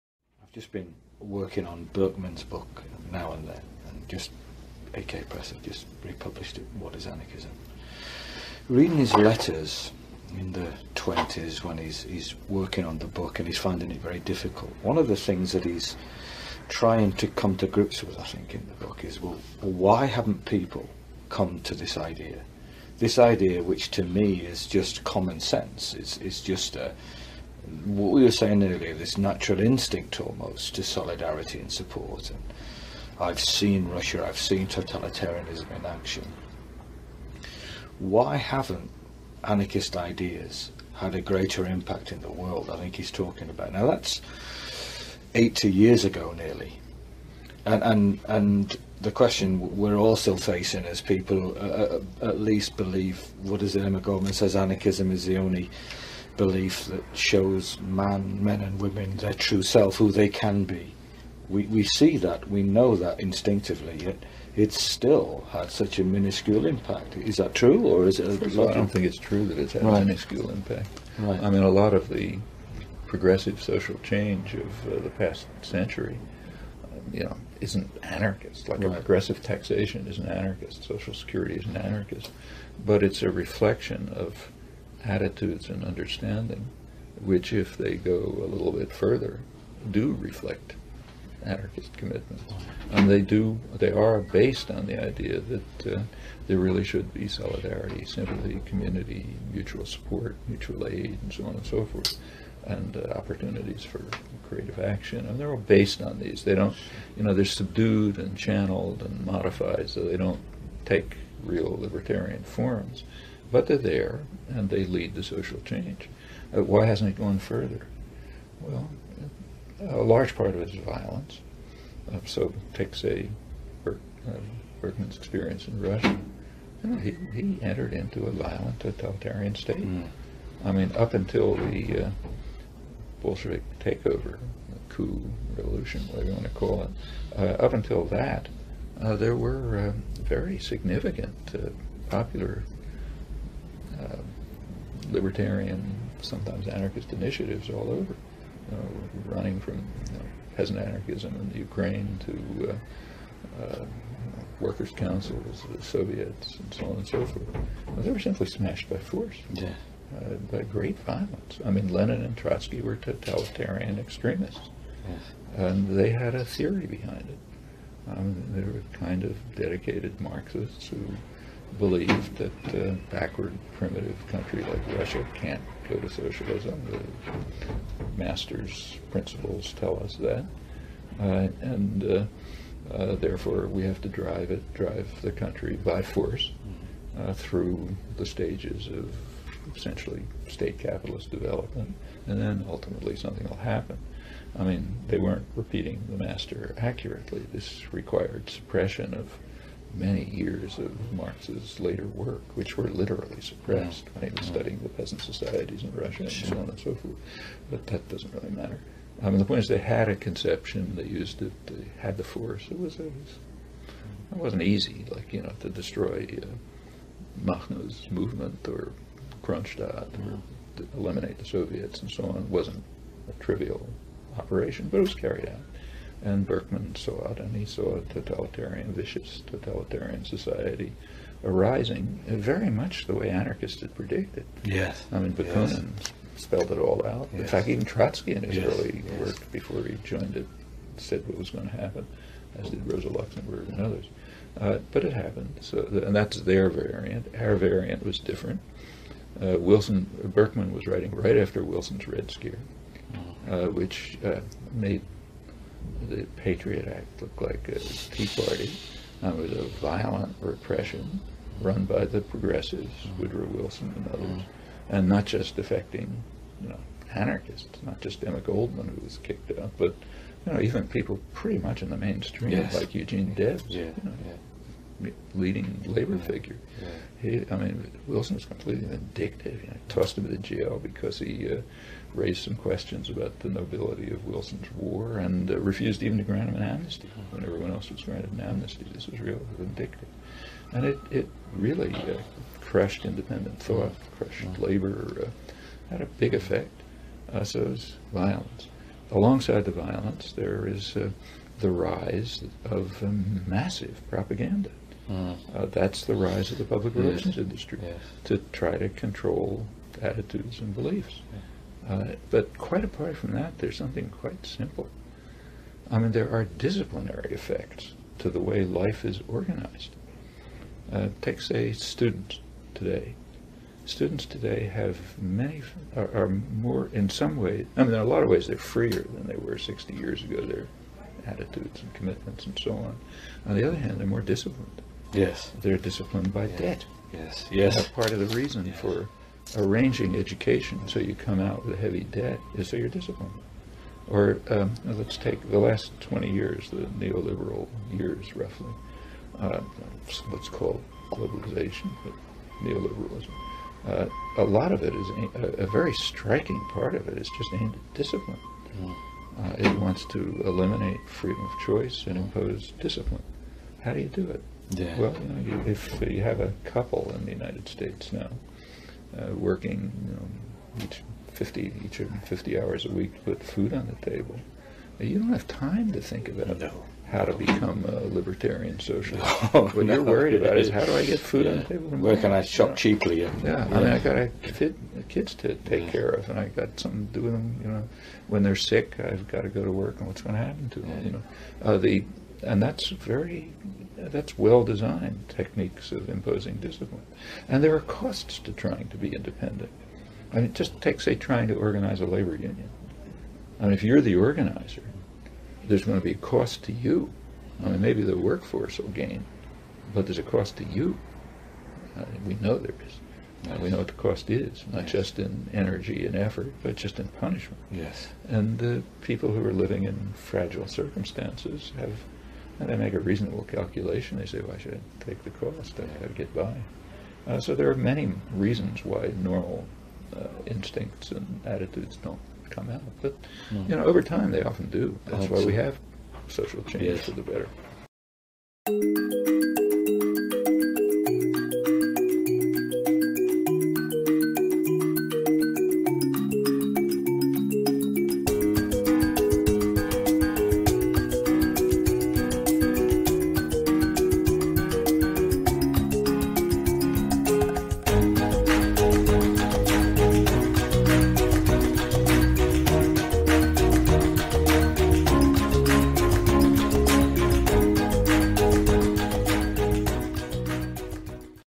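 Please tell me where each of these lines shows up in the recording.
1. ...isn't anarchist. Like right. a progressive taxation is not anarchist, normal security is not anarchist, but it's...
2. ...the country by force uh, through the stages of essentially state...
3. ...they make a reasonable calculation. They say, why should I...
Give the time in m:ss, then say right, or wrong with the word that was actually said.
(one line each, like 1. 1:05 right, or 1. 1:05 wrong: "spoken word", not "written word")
1. 1:17 wrong: "social", not "normal"
2. 3:05 right
3. 7:02 right.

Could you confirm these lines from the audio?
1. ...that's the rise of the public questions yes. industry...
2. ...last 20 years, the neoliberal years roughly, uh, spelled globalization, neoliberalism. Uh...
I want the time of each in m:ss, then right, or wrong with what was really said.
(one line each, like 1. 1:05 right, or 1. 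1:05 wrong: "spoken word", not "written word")
1. 5:05 wrong: "relations", not "questions"
2. 5:45 wrong: "called", not "spelled".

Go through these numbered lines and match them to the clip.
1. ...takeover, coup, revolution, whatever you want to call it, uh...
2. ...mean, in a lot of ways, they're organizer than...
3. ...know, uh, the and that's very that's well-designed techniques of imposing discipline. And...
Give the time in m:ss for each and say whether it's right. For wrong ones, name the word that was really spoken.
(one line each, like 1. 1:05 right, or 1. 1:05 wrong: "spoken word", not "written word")
1. 2:13 right
2. 5:27 wrong: "freer", not "organizer"
3. 6:31 right.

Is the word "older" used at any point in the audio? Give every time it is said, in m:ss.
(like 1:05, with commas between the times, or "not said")
not said.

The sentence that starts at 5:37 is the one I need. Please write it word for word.
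That's part of the reason yes.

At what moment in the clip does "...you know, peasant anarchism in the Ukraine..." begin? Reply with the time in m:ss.
2:29.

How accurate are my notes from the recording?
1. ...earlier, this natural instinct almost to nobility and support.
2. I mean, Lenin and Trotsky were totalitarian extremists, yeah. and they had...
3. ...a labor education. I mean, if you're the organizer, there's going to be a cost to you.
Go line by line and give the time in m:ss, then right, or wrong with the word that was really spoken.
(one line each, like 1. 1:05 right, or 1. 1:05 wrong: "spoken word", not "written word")
1. 0:28 wrong: "solidarity", not "nobility"
2. 2:41 right
3. 6:42 wrong: "union", not "education".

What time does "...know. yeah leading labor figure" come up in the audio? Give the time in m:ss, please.
4:34.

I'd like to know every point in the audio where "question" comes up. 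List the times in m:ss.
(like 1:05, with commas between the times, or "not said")
0:49, 4:42.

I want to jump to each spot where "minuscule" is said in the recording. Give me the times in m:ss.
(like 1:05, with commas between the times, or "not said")
1:06, 1:10.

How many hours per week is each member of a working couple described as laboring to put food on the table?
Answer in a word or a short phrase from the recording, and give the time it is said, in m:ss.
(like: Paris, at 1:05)
50, at 6:12.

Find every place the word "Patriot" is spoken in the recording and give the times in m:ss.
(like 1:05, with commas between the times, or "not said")
4:16.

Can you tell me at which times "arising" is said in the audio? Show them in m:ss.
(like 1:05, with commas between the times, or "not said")
3:51.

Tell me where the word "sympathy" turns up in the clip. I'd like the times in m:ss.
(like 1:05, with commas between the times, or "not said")
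1:38.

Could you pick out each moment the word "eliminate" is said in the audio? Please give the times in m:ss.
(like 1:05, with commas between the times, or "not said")
3:40, 6:00.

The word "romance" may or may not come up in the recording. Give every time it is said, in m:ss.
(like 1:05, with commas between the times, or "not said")
not said.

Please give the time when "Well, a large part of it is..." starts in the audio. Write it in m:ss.
1:58.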